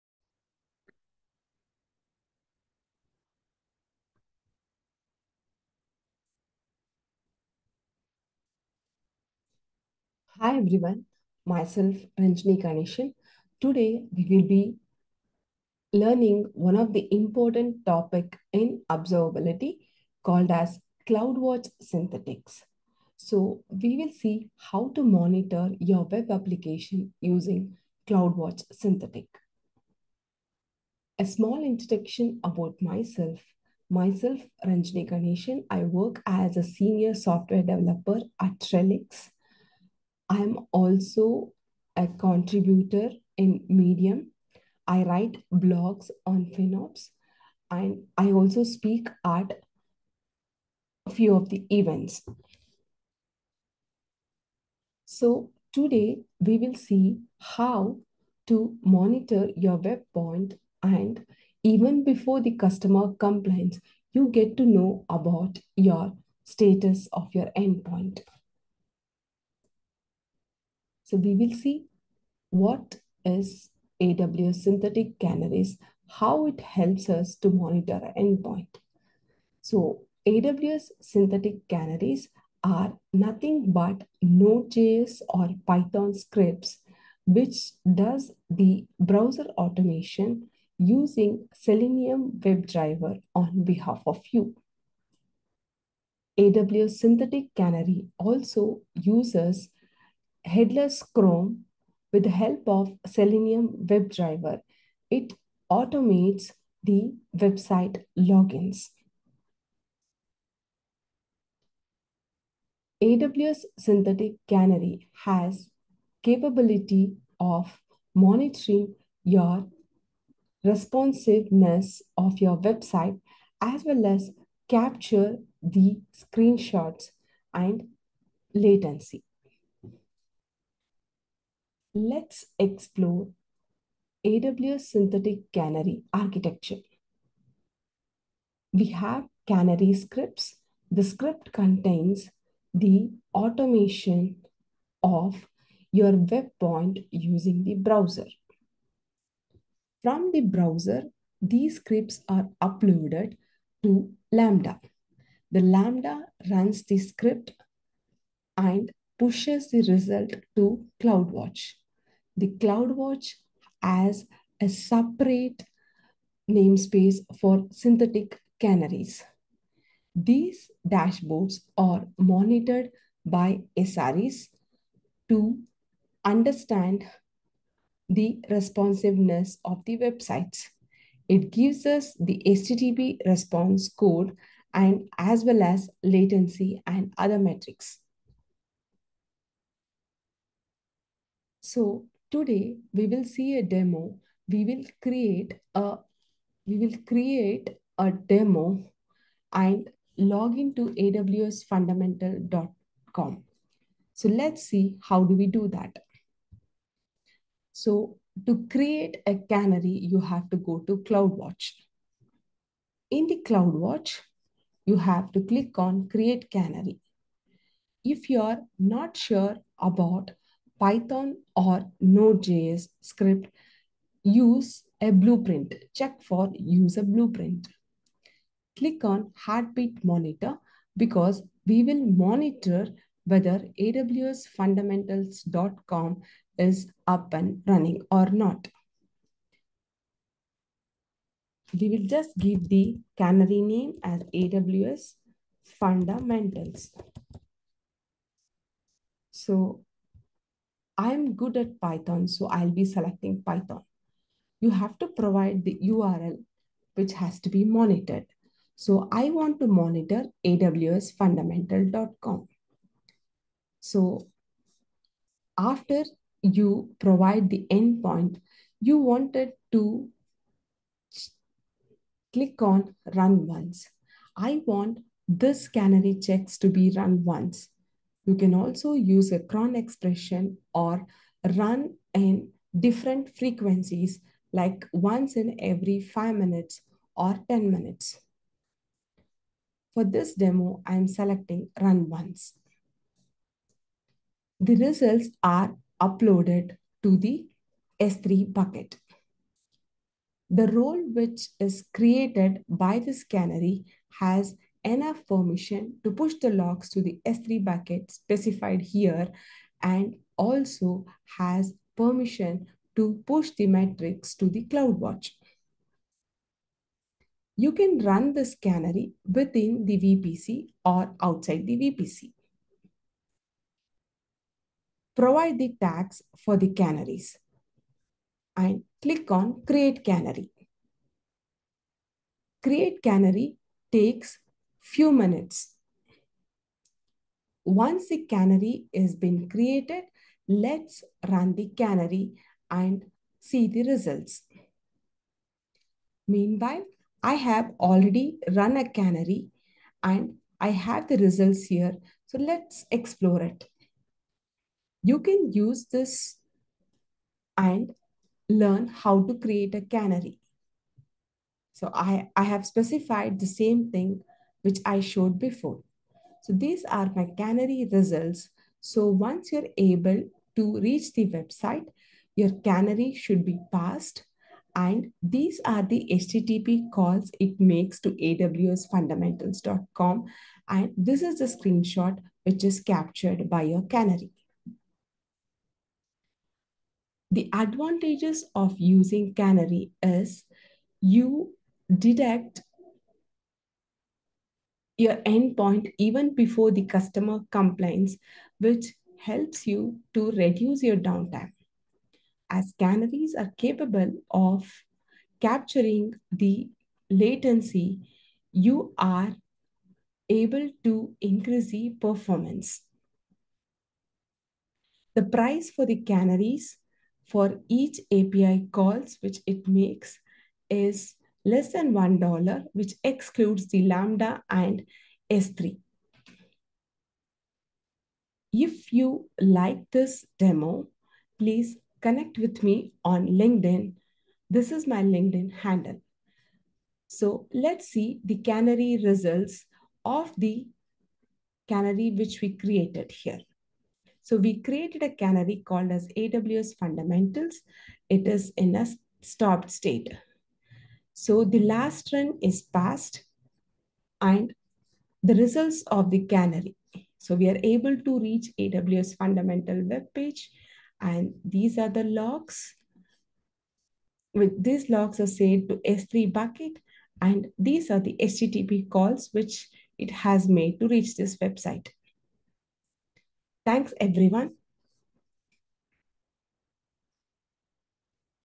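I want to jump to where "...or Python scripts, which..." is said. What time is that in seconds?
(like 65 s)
85 s.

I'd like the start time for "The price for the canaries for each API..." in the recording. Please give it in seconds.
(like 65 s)
415 s.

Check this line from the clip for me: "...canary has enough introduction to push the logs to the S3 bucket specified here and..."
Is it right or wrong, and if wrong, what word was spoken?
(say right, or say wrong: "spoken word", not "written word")
wrong: "permission", not "introduction".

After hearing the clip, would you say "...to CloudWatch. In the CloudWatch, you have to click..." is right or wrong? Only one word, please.
right.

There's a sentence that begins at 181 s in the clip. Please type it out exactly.
It gives us the HTTP response code and as well as latency and other metrics.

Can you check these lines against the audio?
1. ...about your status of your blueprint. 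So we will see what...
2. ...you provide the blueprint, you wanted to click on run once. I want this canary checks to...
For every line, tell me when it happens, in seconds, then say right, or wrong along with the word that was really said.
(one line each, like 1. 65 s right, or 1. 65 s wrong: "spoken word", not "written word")
1. 65 s wrong: "endpoint", not "blueprint"
2. 266 s wrong: "endpoint", not "blueprint".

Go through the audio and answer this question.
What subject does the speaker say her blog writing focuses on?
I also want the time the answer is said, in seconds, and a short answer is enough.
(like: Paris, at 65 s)
FinOps, at 46 s.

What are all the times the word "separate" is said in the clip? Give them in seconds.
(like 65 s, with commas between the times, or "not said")
164 s.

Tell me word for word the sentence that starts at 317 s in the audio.
You can run this canary within the VPC or outside the VPC.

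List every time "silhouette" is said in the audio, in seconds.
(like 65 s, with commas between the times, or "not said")
not said.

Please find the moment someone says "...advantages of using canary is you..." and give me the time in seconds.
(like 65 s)
387 s.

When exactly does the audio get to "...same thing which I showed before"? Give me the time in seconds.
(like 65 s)
363 s.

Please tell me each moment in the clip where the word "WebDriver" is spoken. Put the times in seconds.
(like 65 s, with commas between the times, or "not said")
92 s, 103 s.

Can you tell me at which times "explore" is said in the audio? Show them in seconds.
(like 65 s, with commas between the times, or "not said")
132 s, 352 s.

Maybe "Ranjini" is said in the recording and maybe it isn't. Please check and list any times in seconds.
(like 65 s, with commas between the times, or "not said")
12 s, 34 s.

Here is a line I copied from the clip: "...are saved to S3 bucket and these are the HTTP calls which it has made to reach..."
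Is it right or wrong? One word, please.
right.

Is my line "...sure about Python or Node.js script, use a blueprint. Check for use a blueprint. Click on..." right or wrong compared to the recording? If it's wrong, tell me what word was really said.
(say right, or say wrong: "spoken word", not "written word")
right.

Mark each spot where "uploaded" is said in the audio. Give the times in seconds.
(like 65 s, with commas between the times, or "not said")
152 s, 296 s.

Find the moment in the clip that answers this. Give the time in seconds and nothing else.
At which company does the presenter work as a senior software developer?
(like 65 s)
38 s.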